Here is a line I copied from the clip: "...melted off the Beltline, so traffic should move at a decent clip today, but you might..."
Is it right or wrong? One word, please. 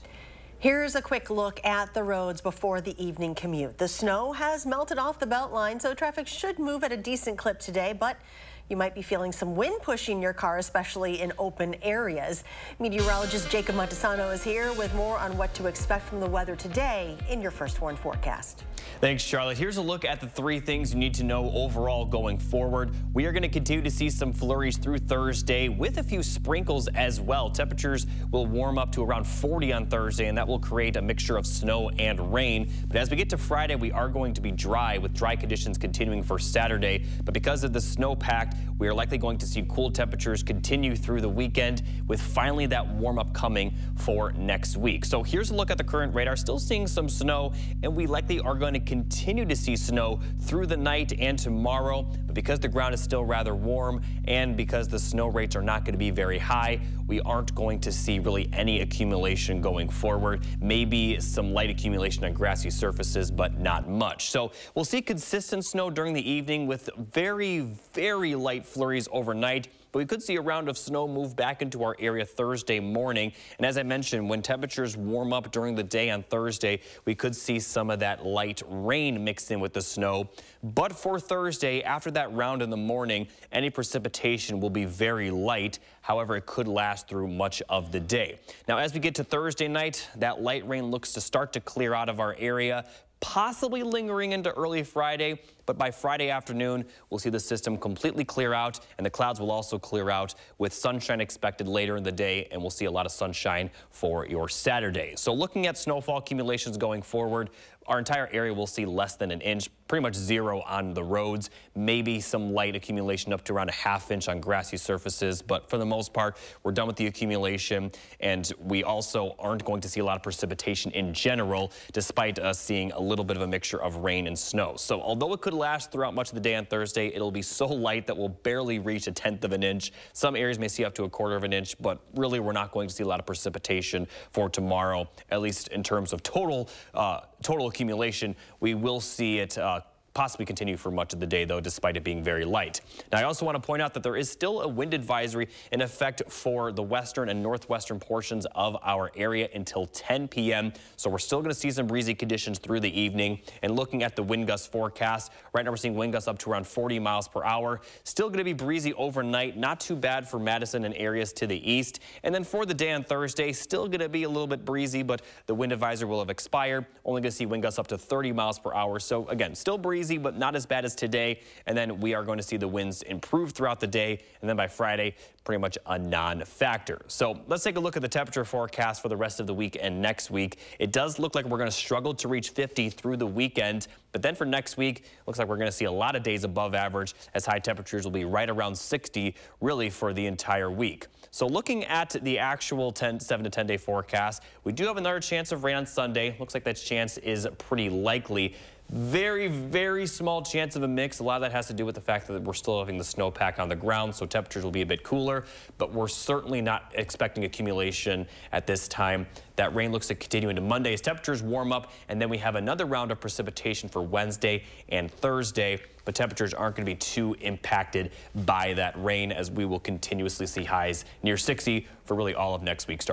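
right.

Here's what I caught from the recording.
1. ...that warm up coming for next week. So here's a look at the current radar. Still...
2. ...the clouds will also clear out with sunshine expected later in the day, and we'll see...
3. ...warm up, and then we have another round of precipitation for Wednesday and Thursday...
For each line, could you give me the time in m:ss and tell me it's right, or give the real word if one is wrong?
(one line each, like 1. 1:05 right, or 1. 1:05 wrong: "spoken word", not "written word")
1. 0:42 right
2. 1:39 right
3. 3:31 right.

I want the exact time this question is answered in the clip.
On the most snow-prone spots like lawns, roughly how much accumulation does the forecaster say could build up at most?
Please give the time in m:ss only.
1:53.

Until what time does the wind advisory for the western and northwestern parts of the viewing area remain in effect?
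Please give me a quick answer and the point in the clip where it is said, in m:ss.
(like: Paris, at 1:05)
10 p.m., at 2:29.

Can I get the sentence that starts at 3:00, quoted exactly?
It does look like we're going to struggle to reach 50 through the weekend.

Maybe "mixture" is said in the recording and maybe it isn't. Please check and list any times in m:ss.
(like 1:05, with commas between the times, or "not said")
0:31, 2:03.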